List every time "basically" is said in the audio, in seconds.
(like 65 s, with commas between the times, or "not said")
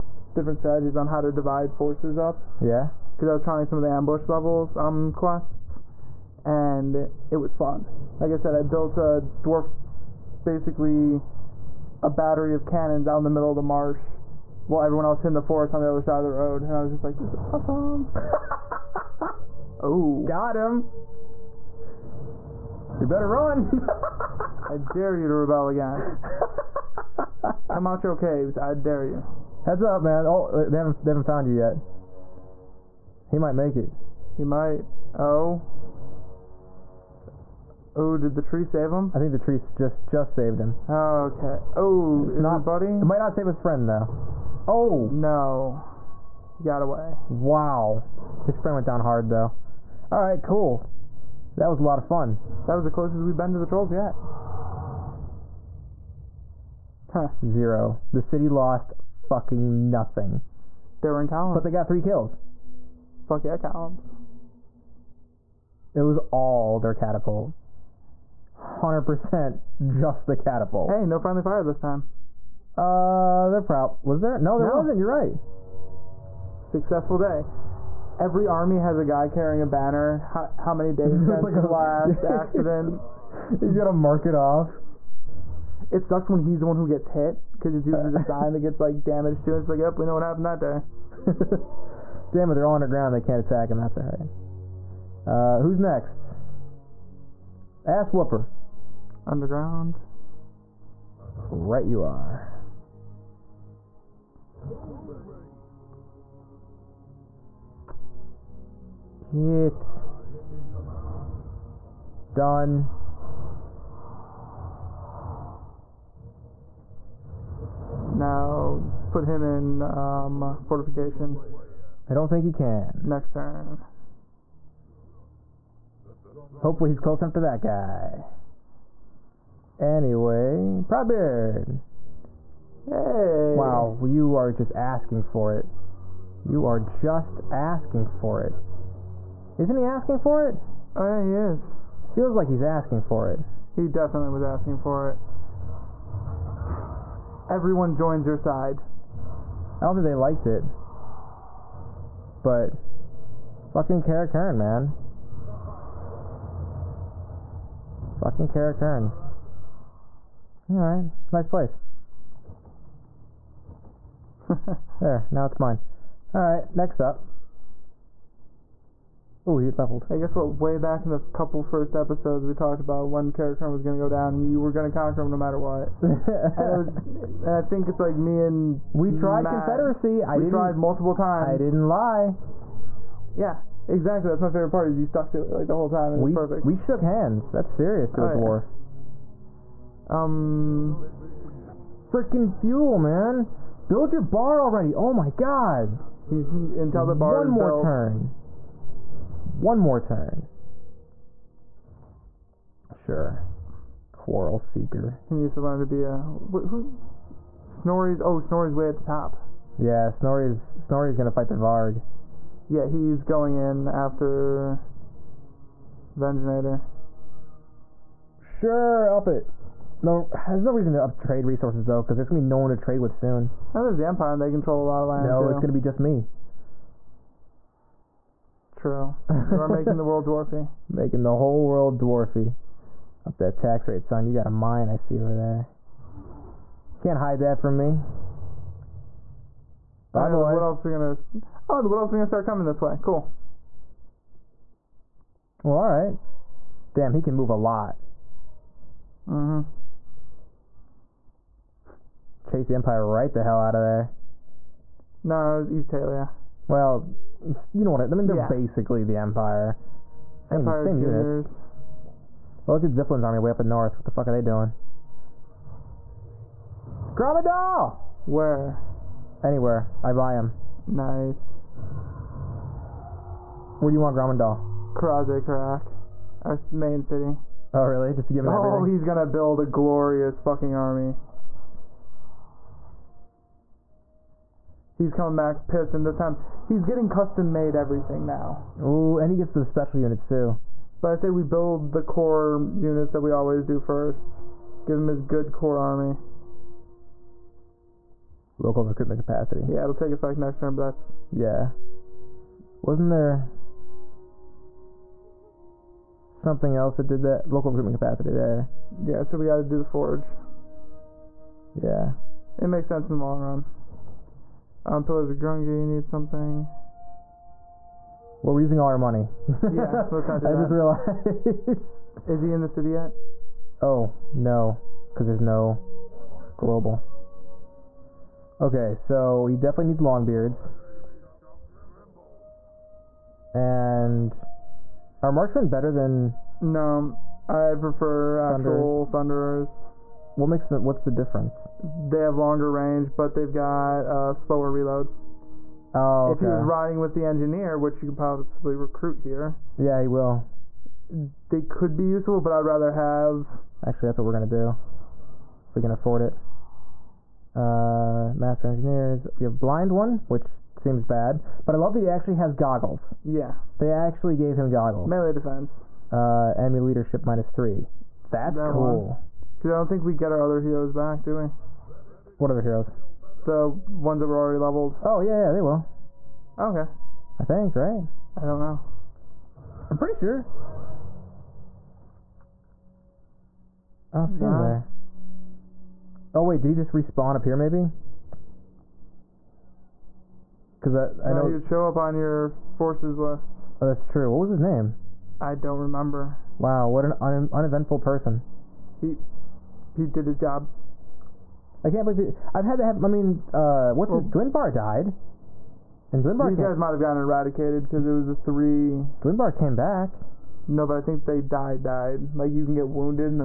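10 s, 258 s.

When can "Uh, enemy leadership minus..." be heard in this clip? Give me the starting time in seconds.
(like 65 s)
366 s.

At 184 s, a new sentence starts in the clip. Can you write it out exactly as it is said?
Is you stuck to it like the whole time.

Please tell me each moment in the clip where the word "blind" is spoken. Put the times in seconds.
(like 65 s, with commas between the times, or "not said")
359 s.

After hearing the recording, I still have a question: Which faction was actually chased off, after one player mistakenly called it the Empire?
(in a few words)
Estalia.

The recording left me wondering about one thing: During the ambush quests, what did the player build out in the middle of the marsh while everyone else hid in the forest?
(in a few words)
a battery of cannons.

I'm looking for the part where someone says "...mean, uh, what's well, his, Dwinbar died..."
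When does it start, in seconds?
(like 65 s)
403 s.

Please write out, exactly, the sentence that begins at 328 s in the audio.
Okay, so he definitely needs Longbeards.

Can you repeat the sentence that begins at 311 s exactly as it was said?
Yeah, it makes sense in the long run.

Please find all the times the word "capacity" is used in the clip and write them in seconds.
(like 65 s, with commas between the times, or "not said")
299 s, 307 s.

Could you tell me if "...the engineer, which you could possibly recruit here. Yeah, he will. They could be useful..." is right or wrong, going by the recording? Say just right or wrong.
right.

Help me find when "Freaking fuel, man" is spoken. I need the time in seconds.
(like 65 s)
192 s.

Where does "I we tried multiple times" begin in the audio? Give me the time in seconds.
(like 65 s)
180 s.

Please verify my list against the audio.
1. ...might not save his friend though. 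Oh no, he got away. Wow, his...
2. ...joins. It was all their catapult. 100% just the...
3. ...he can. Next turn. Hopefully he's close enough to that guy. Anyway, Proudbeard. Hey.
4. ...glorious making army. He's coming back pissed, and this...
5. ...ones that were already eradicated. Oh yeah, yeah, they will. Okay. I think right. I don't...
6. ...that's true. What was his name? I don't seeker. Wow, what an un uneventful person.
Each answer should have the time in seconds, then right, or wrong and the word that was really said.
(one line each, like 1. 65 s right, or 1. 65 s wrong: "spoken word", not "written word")
1. 43 s right
2. 63 s wrong: "columns", not "joins"
3. 122 s right
4. 279 s wrong: "fucking", not "making"
5. 373 s wrong: "leveled", not "eradicated"
6. 393 s wrong: "remember", not "seeker".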